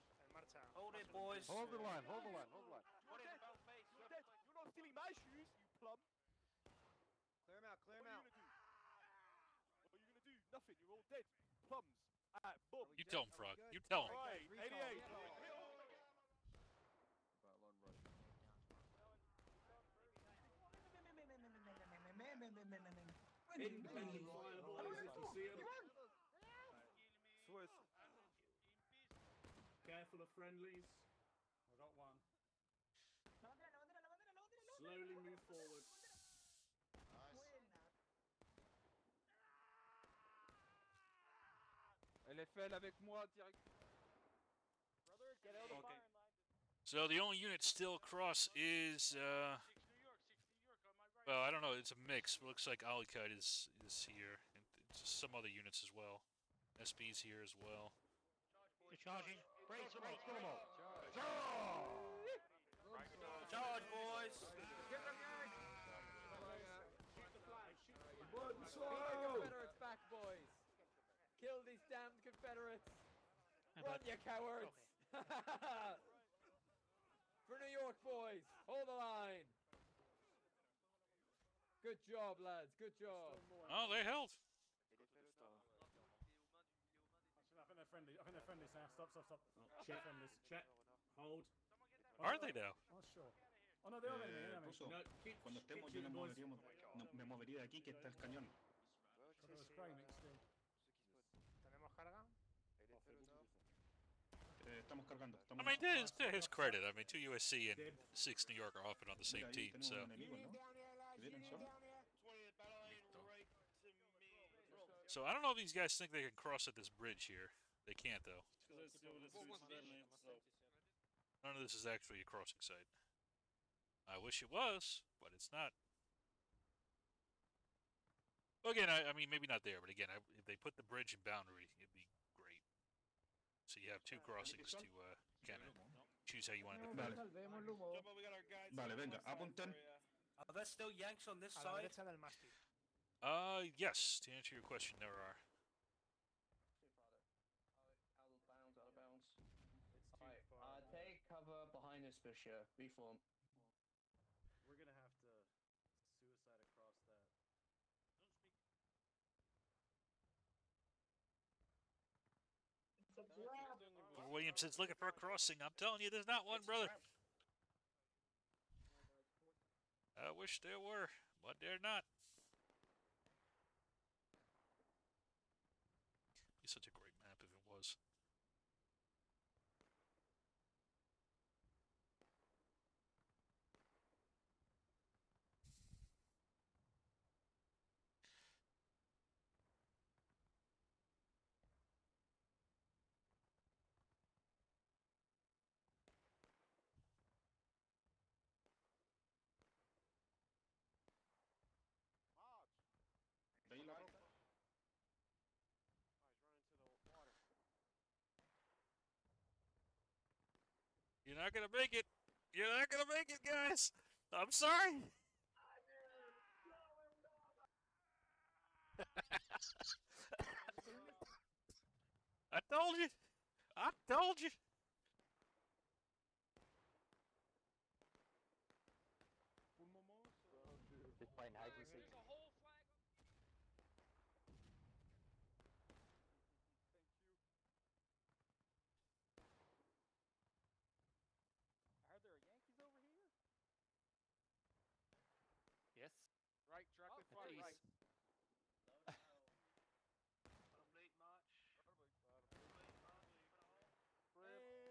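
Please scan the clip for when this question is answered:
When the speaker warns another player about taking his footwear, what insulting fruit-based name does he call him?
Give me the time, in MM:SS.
00:05.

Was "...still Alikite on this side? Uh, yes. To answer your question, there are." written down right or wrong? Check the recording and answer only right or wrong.
wrong.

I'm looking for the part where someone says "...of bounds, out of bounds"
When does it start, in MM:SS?
02:28.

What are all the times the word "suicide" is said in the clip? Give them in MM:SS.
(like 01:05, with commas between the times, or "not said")
02:36.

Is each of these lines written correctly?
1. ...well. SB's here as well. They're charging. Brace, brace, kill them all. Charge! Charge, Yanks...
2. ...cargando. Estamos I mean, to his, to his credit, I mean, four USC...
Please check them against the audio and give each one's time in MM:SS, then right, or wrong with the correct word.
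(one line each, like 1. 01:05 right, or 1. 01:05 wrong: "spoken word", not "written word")
1. 00:55 wrong: "Charge", not "Yanks"
2. 01:45 wrong: "two", not "four".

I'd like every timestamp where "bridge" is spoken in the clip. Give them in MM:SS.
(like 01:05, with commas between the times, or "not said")
01:56, 02:10.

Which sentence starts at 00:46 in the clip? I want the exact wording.
So the only unit still across is uh, well, I don't know.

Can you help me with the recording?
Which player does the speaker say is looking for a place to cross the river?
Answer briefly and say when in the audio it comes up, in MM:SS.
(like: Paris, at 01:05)
Williamson, at 02:44.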